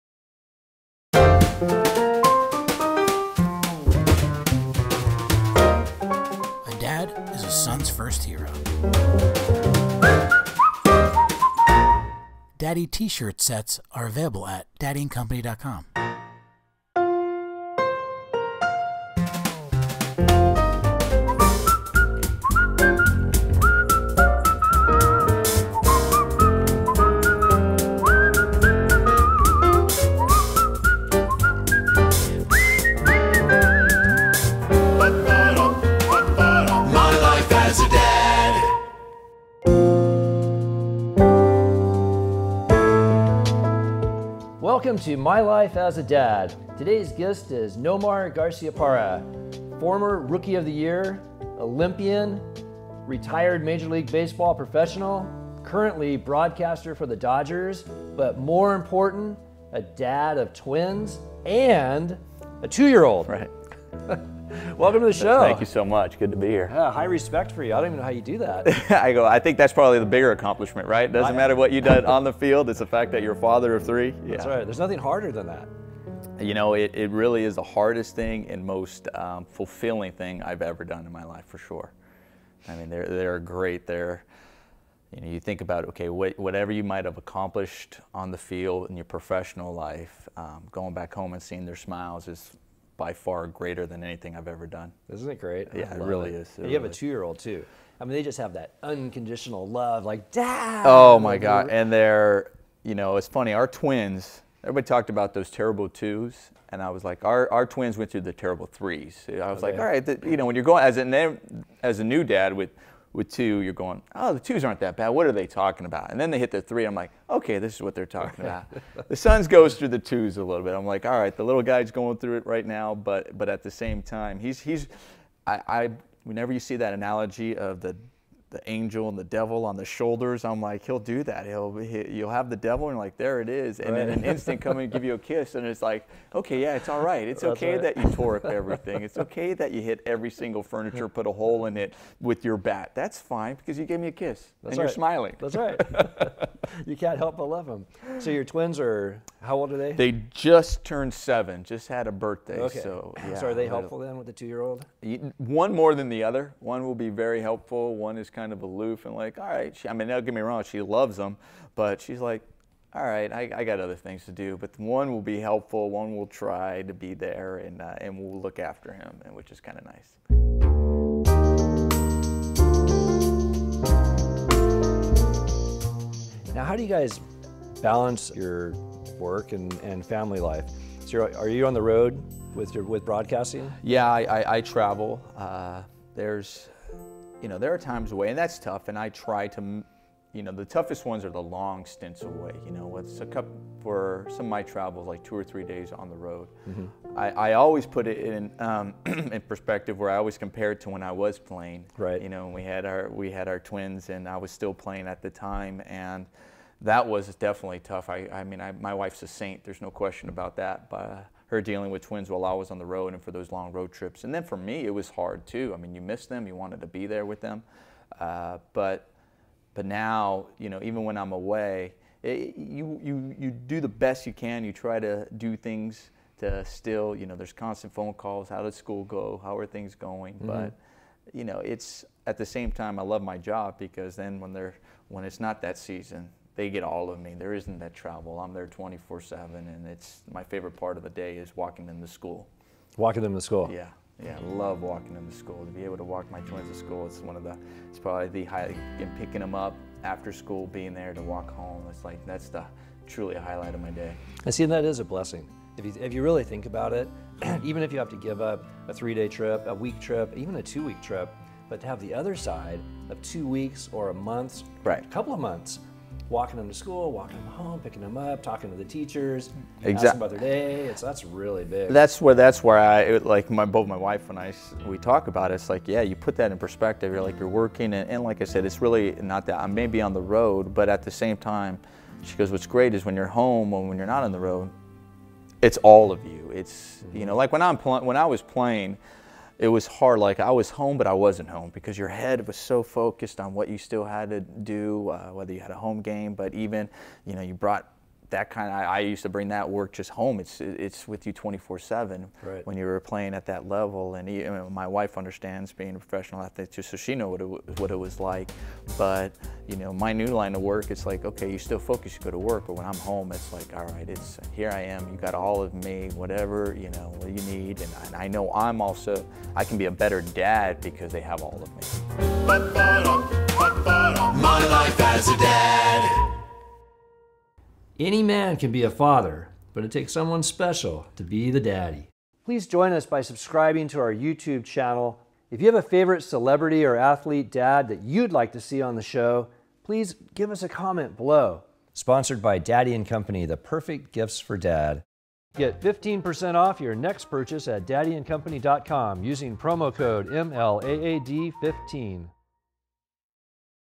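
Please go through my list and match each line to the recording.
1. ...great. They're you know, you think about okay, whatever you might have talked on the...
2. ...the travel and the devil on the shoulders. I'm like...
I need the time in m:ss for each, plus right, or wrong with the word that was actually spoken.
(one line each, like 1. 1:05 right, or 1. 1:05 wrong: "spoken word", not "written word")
1. 1:23 wrong: "accomplished", not "talked"
2. 2:08 wrong: "angel", not "travel".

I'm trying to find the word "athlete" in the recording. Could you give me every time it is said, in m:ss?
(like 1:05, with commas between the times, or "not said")
5:06, 5:36.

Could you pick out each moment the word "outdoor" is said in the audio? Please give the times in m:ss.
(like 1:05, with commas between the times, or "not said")
not said.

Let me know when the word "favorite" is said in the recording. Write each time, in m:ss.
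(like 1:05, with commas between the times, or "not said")
4:00, 5:35.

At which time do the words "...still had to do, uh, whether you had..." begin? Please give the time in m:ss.
4:53.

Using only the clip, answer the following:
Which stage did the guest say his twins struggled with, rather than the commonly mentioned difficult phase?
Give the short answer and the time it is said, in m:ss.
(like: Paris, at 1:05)
terrible threes, at 1:48.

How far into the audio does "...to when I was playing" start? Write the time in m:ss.
3:20.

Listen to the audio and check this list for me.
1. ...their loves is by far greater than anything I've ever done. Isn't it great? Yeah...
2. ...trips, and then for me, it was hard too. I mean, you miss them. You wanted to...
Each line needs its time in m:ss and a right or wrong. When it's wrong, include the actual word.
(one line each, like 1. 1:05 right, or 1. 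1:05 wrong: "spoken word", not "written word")
1. 1:31 wrong: "smiles", not "loves"
2. 3:33 right.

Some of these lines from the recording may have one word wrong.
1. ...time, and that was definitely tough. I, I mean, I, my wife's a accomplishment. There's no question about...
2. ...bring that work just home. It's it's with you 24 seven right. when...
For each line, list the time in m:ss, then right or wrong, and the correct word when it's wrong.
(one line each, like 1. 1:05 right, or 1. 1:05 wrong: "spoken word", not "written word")
1. 3:25 wrong: "saint", not "accomplishment"
2. 4:59 right.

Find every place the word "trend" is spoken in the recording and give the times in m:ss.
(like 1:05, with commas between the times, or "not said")
not said.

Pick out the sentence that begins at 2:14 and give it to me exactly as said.
in an instant come and give you a kiss, and it's like, okay, yeah, it's all right.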